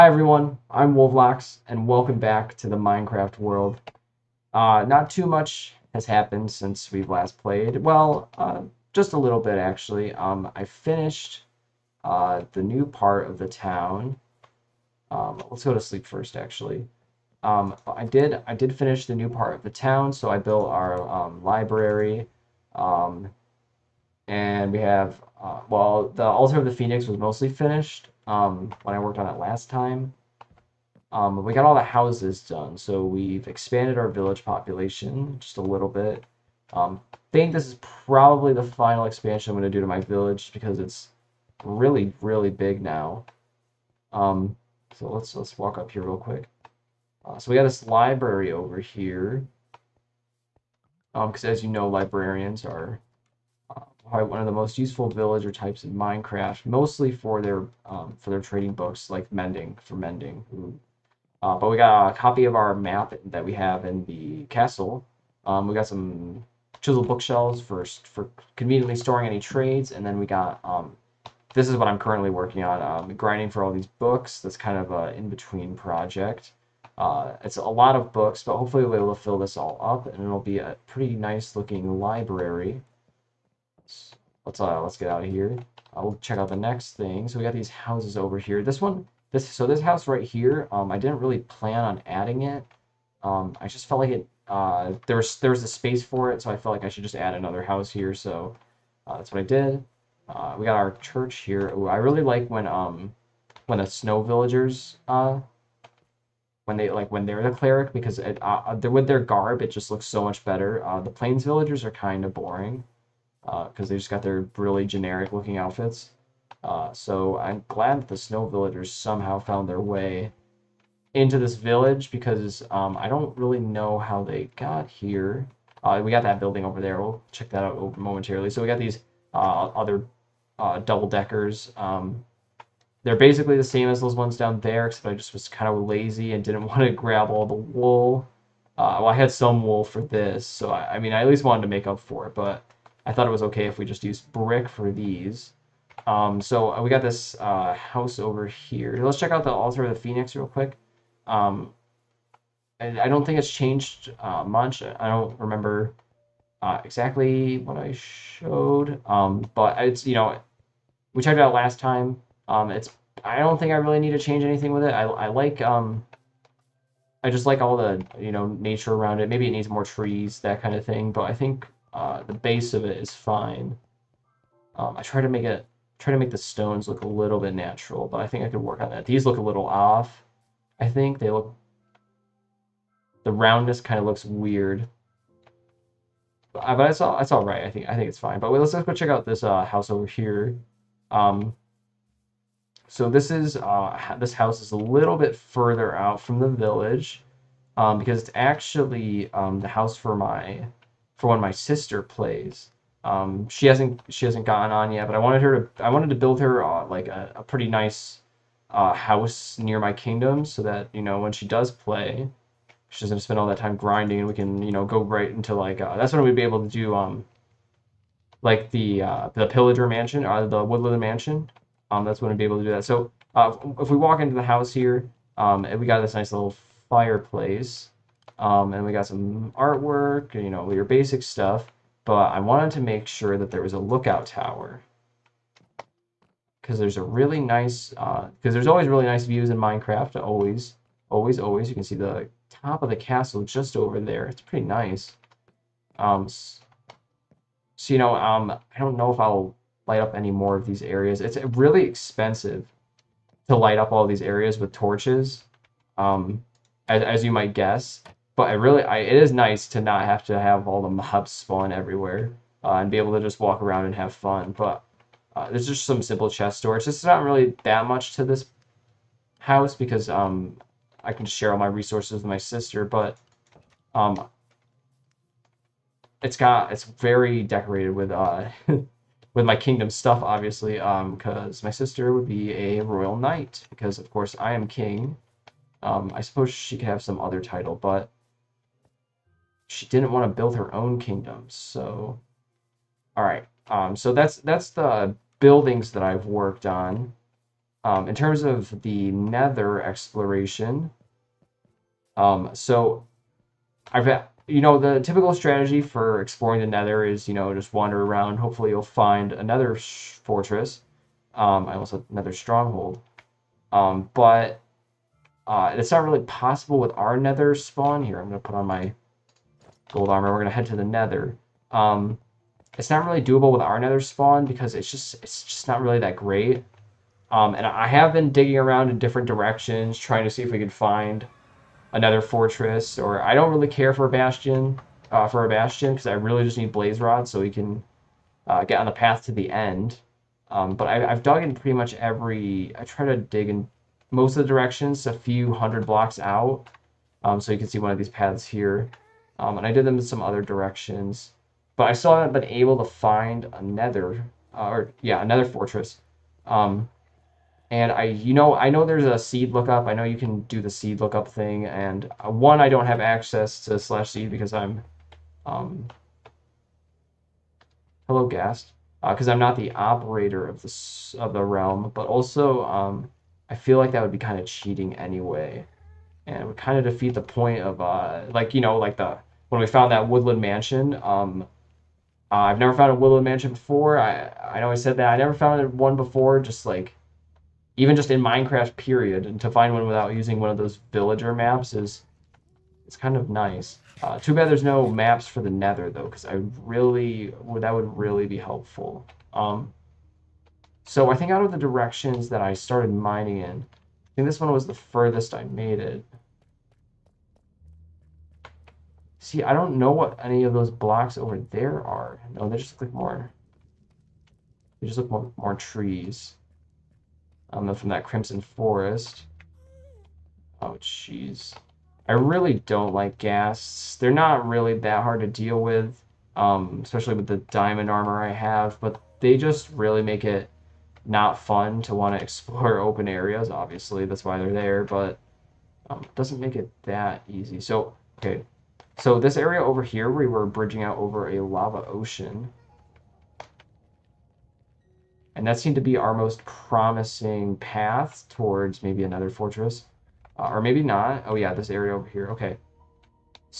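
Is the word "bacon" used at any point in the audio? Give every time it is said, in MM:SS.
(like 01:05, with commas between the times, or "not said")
not said.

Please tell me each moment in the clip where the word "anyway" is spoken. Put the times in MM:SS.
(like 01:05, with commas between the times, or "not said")
06:14.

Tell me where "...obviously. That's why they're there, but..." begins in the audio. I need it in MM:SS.
07:13.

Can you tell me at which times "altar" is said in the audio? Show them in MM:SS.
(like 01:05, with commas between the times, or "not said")
00:26, 02:29.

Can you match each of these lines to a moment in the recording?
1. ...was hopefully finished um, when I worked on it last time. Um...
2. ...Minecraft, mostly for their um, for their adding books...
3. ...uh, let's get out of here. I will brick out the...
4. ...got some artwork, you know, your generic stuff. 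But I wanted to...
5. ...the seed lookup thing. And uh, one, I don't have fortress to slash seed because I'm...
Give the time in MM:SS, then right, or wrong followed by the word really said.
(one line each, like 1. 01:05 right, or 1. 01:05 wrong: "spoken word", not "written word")
1. 00:27 wrong: "mostly", not "hopefully"
2. 00:55 wrong: "trading", not "adding"
3. 01:24 wrong: "check", not "brick"
4. 03:48 wrong: "basic", not "generic"
5. 06:00 wrong: "access", not "fortress".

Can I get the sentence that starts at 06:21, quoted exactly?
Um, uh, I've never found a woodland mansion before.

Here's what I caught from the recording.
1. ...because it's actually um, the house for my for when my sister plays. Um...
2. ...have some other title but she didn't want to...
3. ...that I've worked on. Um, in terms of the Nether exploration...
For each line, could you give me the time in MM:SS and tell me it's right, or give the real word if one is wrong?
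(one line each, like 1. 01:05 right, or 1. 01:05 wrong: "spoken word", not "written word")
1. 03:17 right
2. 04:46 right
3. 04:55 right.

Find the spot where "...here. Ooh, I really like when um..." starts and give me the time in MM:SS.
01:41.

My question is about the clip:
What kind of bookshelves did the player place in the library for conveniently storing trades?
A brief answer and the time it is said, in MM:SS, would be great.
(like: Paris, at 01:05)
Chisel bookshelves, at 01:06.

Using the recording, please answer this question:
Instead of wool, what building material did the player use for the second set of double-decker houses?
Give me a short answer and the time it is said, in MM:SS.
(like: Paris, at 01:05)
Brick, at 02:24.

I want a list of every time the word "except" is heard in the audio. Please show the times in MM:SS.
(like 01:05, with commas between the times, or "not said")
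02:14.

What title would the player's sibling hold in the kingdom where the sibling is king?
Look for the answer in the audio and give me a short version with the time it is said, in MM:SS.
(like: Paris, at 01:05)
Royal knight, at 04:42.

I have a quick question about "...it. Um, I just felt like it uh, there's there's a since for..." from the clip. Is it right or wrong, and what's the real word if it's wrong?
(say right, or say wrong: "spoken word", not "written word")
wrong: "space", not "since".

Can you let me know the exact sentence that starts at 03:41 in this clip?
Um, that's when we'd be able to do that.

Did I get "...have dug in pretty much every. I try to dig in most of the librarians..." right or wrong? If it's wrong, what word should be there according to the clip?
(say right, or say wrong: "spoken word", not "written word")
wrong: "directions", not "librarians".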